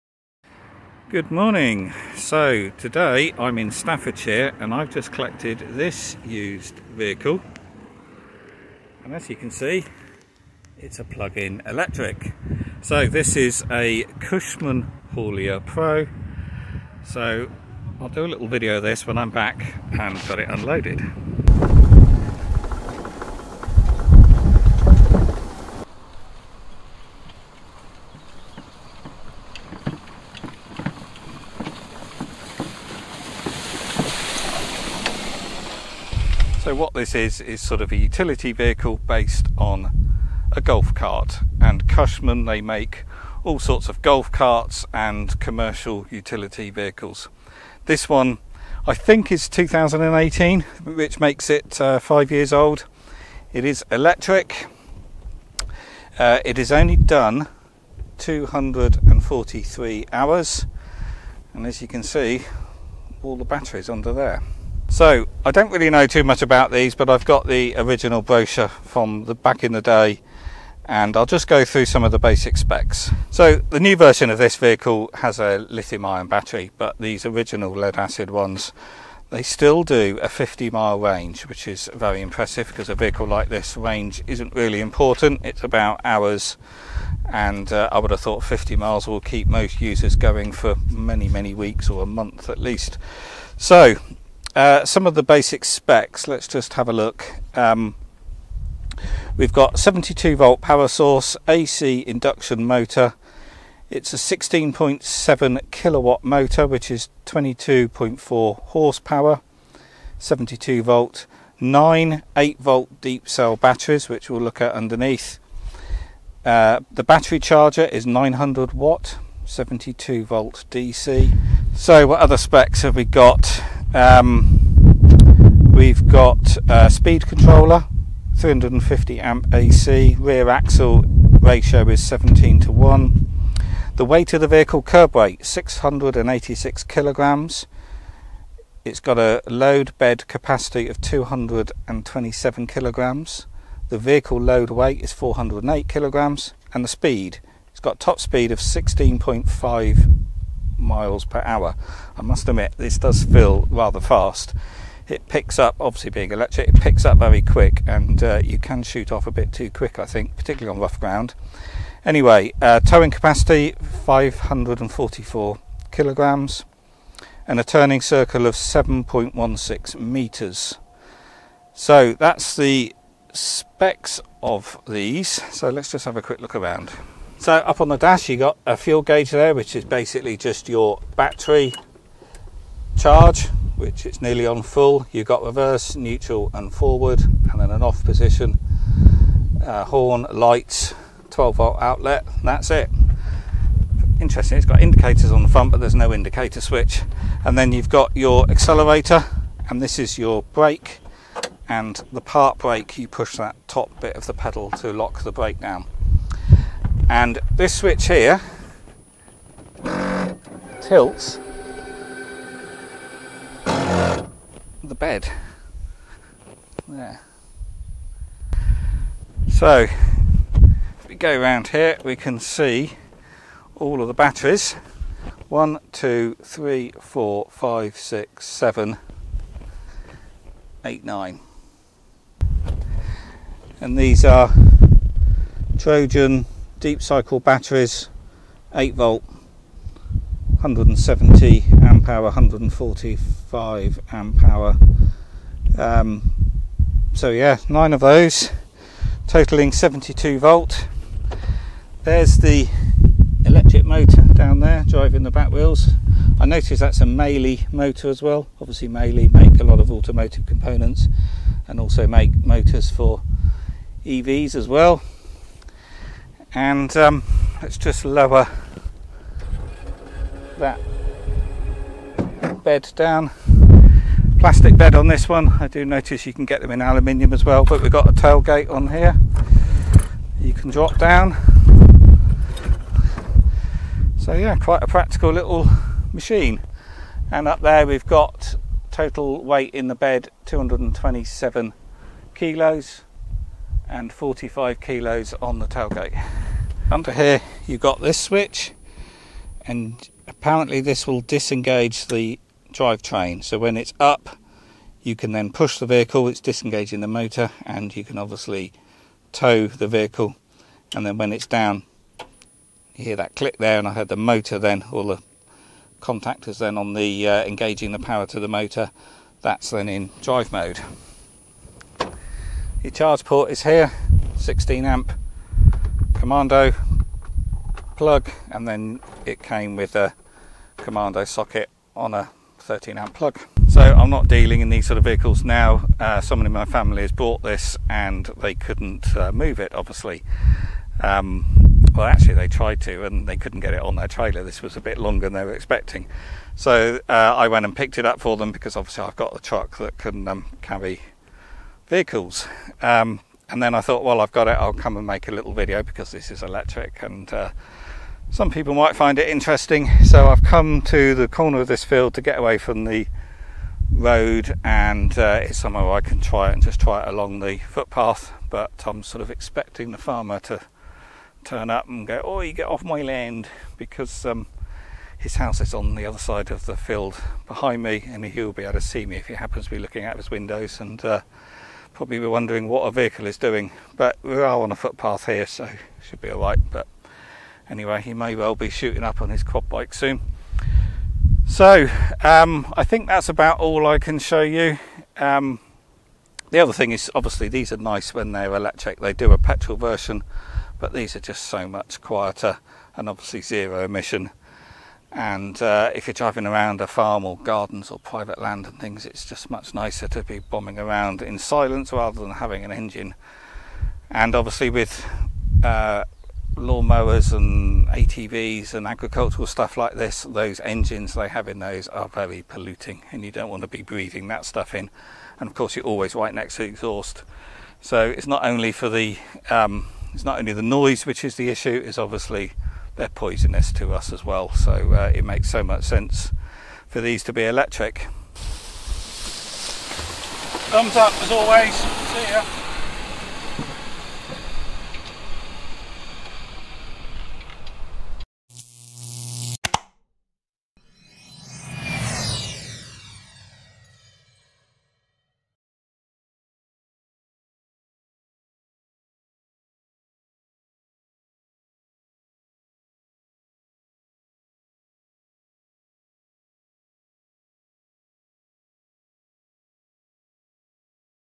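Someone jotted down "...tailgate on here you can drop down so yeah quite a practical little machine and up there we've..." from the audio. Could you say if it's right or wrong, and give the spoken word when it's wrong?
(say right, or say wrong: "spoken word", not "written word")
right.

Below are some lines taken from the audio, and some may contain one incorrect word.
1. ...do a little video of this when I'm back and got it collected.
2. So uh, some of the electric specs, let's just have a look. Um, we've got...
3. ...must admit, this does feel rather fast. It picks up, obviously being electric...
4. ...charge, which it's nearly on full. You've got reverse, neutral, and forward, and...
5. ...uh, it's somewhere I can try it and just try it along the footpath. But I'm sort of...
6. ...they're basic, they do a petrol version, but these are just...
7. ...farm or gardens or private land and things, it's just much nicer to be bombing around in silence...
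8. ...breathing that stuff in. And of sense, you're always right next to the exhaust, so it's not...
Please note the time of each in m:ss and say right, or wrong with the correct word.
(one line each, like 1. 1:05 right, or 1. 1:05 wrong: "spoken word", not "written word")
1. 0:18 wrong: "unloaded", not "collected"
2. 1:33 wrong: "basic", not "electric"
3. 2:32 right
4. 3:02 right
5. 6:05 right
6. 6:38 wrong: "electric", not "basic"
7. 6:46 right
8. 7:03 wrong: "course", not "sense".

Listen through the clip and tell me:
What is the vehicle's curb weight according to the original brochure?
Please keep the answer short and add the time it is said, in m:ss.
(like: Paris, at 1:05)
686 kilograms, at 2:15.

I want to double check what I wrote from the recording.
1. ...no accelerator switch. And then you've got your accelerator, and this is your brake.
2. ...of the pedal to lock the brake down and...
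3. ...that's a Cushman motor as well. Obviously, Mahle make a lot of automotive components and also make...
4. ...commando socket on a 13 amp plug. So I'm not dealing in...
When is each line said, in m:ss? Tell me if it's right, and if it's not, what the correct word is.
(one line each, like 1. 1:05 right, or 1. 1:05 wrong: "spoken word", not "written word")
1. 3:15 wrong: "indicator", not "accelerator"
2. 3:24 right
3. 4:16 wrong: "Mahle", not "Cushman"
4. 5:30 right.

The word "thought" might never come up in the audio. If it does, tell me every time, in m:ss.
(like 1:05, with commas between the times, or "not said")
1:28, 5:53.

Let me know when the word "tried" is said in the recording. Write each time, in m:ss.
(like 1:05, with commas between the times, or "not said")
5:42.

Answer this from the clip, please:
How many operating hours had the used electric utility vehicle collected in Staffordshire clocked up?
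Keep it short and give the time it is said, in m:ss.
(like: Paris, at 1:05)
243 hours, at 0:58.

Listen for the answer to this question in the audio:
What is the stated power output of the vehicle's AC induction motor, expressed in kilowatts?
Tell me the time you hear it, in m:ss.
1:44.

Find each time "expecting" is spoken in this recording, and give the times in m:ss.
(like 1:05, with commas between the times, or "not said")
5:45, 6:09.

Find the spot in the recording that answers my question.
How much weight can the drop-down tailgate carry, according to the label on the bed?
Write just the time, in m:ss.
4:54.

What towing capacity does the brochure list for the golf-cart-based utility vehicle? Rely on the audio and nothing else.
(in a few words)
544 kilograms.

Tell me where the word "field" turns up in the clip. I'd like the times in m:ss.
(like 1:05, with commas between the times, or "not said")
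6:01, 6:16.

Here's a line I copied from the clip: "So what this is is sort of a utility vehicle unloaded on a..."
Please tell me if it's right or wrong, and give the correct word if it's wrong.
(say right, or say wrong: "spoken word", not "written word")
wrong: "based", not "unloaded".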